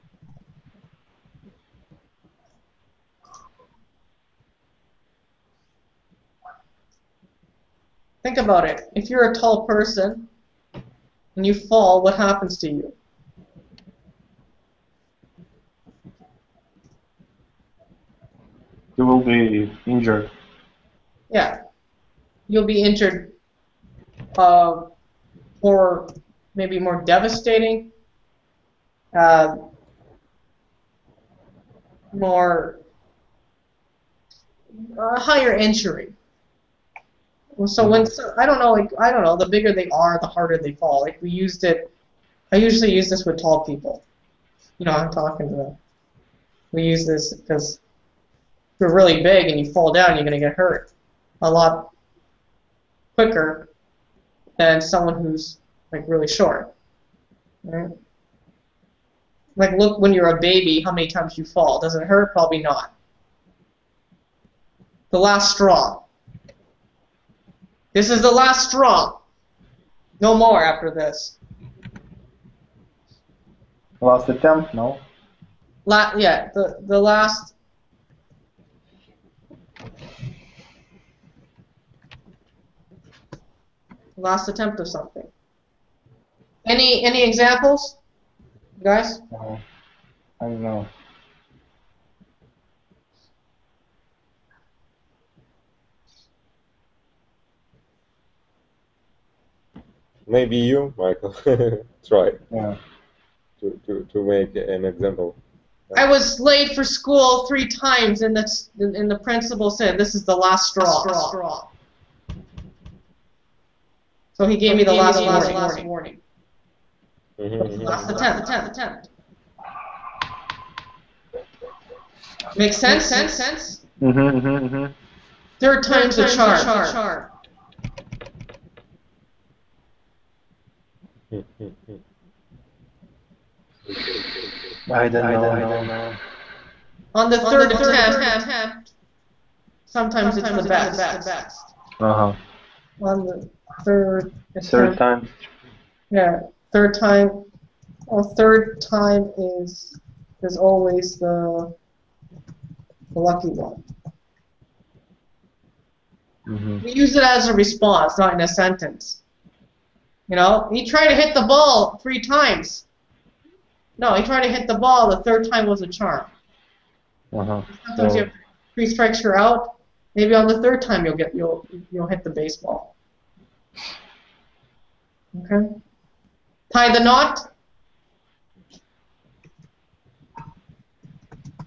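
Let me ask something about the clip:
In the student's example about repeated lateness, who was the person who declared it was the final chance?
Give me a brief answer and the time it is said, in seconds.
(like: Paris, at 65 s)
the principal, at 109 s.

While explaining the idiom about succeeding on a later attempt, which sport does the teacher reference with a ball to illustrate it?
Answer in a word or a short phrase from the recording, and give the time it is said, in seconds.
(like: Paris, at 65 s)
baseball, at 172 s.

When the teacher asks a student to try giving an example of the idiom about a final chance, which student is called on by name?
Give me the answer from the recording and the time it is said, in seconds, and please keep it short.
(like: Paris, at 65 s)
Michael, at 100 s.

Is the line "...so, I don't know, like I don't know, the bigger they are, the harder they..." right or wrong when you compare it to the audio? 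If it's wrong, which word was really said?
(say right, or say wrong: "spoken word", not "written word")
right.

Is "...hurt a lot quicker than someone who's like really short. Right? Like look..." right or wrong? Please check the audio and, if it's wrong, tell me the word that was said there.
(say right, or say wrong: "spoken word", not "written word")
right.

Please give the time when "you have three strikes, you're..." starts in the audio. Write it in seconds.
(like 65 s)
168 s.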